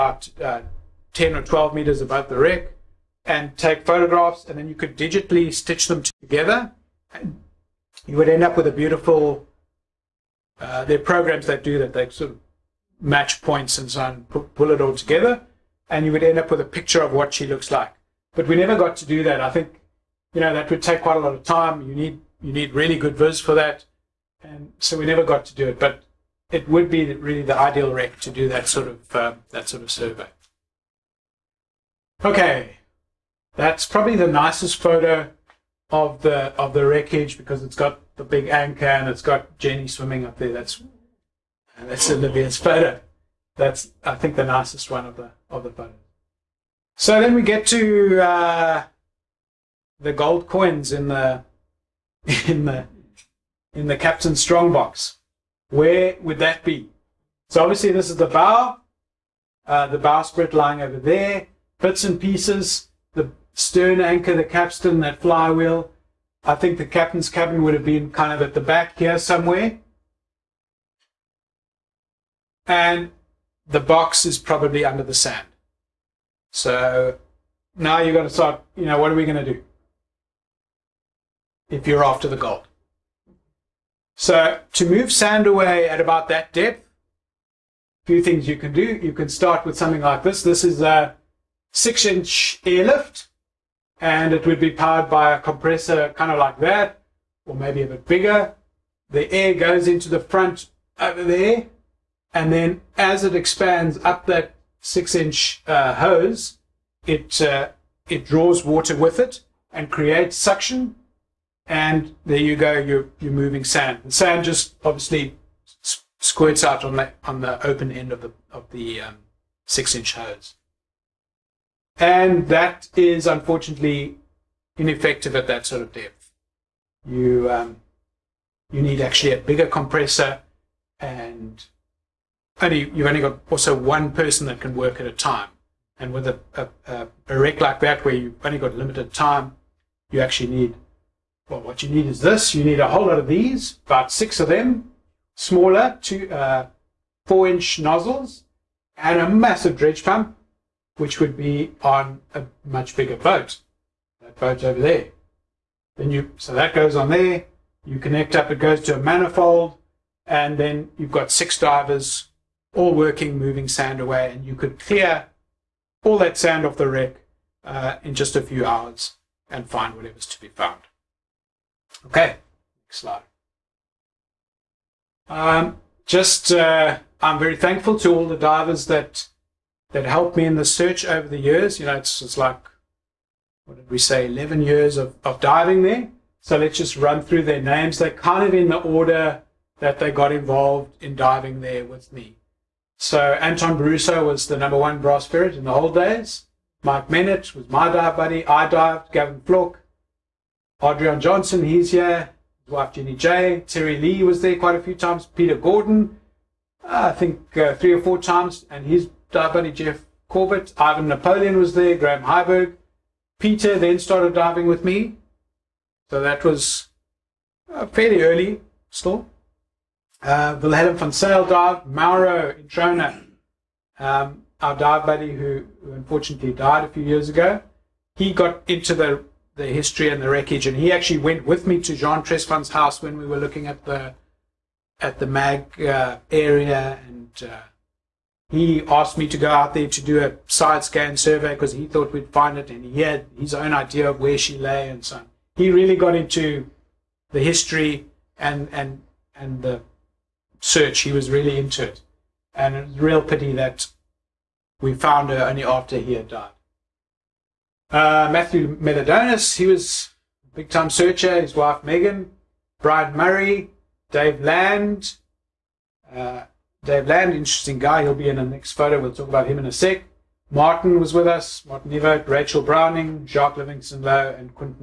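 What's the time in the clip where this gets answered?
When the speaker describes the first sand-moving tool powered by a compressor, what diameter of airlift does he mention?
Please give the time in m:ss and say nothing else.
1:31.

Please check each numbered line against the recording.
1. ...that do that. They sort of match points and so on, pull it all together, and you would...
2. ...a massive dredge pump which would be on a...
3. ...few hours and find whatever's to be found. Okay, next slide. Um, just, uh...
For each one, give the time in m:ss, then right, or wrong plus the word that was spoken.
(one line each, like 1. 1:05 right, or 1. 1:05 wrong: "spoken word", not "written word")
1. 0:11 right
2. 2:29 right
3. 2:48 right.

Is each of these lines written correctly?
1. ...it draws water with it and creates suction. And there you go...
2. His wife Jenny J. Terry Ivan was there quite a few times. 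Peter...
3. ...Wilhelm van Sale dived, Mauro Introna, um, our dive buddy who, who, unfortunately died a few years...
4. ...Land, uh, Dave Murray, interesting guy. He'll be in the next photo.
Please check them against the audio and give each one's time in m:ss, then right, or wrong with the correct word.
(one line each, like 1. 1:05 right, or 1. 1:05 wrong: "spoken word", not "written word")
1. 1:48 right
2. 3:22 wrong: "Lee", not "Ivan"
3. 3:40 right
4. 4:24 wrong: "Land", not "Murray".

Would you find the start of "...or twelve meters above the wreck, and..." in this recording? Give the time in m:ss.
0:01.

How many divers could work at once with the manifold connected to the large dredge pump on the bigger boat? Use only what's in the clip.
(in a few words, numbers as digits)
6.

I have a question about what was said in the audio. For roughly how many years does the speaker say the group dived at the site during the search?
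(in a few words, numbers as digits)
11 years.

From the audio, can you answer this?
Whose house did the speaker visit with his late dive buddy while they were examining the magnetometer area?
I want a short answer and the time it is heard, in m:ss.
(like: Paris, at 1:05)
Jean Tresfon, at 3:51.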